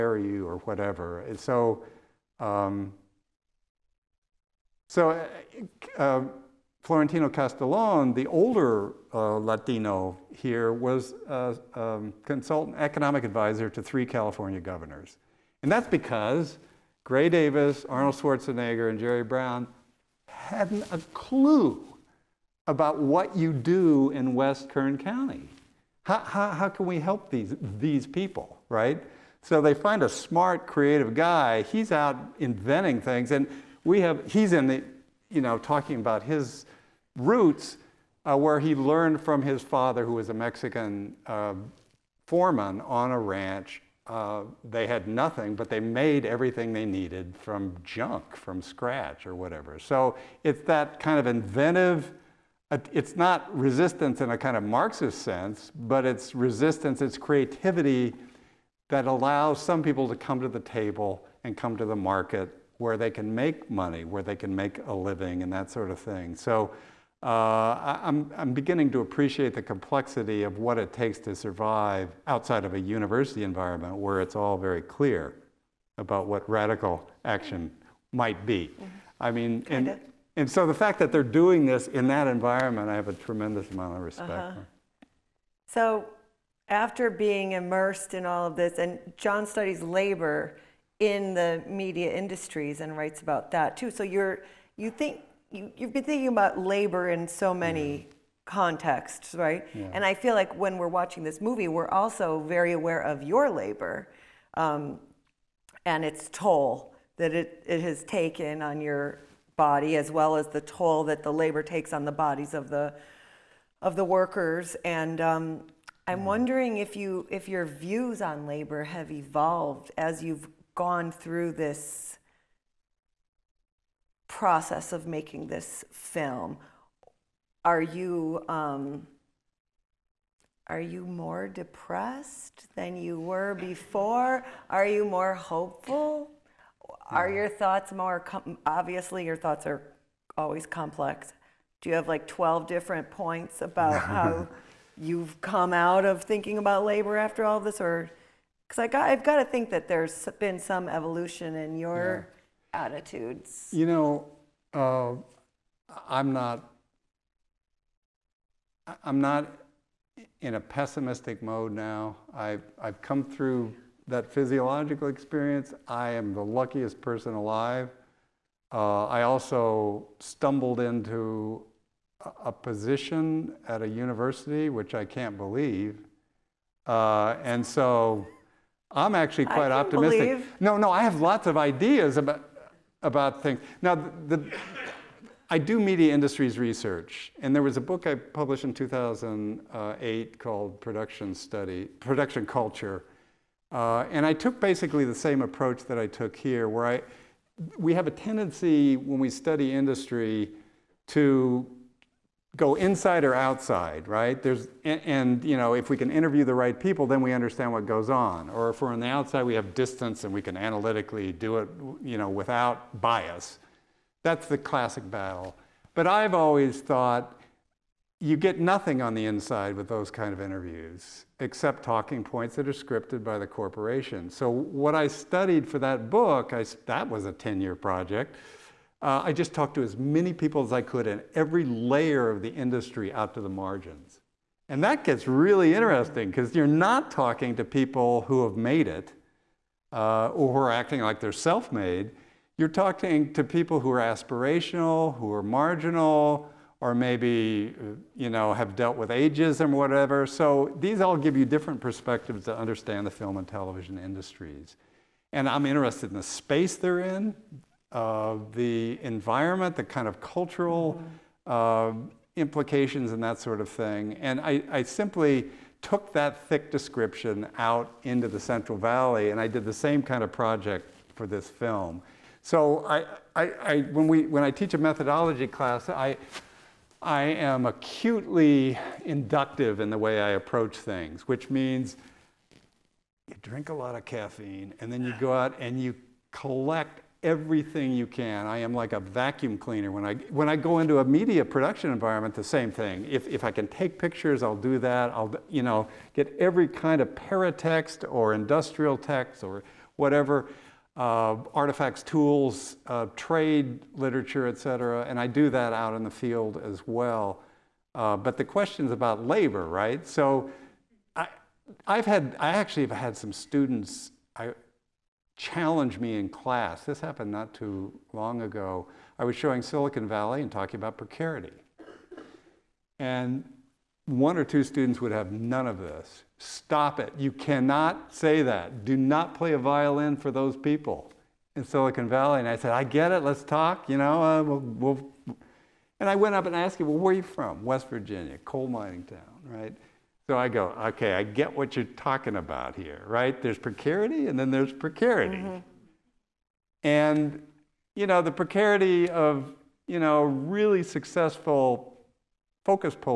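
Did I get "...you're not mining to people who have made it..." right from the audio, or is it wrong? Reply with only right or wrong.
wrong.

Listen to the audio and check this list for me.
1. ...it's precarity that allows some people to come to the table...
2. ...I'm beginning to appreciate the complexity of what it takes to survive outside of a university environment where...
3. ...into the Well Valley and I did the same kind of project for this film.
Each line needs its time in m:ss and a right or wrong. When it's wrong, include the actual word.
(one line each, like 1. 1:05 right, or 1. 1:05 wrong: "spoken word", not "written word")
1. 0:57 wrong: "creativity", not "precarity"
2. 1:08 right
3. 4:28 wrong: "Central", not "Well".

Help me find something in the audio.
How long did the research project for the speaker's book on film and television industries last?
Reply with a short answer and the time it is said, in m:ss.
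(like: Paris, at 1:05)
10 years, at 3:47.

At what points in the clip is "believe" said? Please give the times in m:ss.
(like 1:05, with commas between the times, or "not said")
2:55, 3:00.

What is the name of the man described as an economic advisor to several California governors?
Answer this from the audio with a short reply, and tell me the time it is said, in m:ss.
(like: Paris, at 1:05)
Florentino Castellon, at 0:06.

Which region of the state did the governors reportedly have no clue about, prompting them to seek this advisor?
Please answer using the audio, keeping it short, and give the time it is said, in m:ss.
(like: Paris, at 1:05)
West Kern County, at 0:24.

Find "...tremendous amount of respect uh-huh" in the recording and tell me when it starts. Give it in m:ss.
1:23.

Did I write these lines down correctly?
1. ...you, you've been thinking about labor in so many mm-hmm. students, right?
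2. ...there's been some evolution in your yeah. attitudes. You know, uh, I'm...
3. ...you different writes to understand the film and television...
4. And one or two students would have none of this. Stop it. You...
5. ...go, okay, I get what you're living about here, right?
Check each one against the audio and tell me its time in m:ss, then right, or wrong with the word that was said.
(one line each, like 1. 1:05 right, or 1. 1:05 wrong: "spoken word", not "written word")
1. 1:35 wrong: "contexts", not "students"
2. 2:29 right
3. 4:11 wrong: "perspectives", not "writes"
4. 5:22 right
5. 5:40 wrong: "talking", not "living".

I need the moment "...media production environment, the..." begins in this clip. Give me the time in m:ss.
4:51.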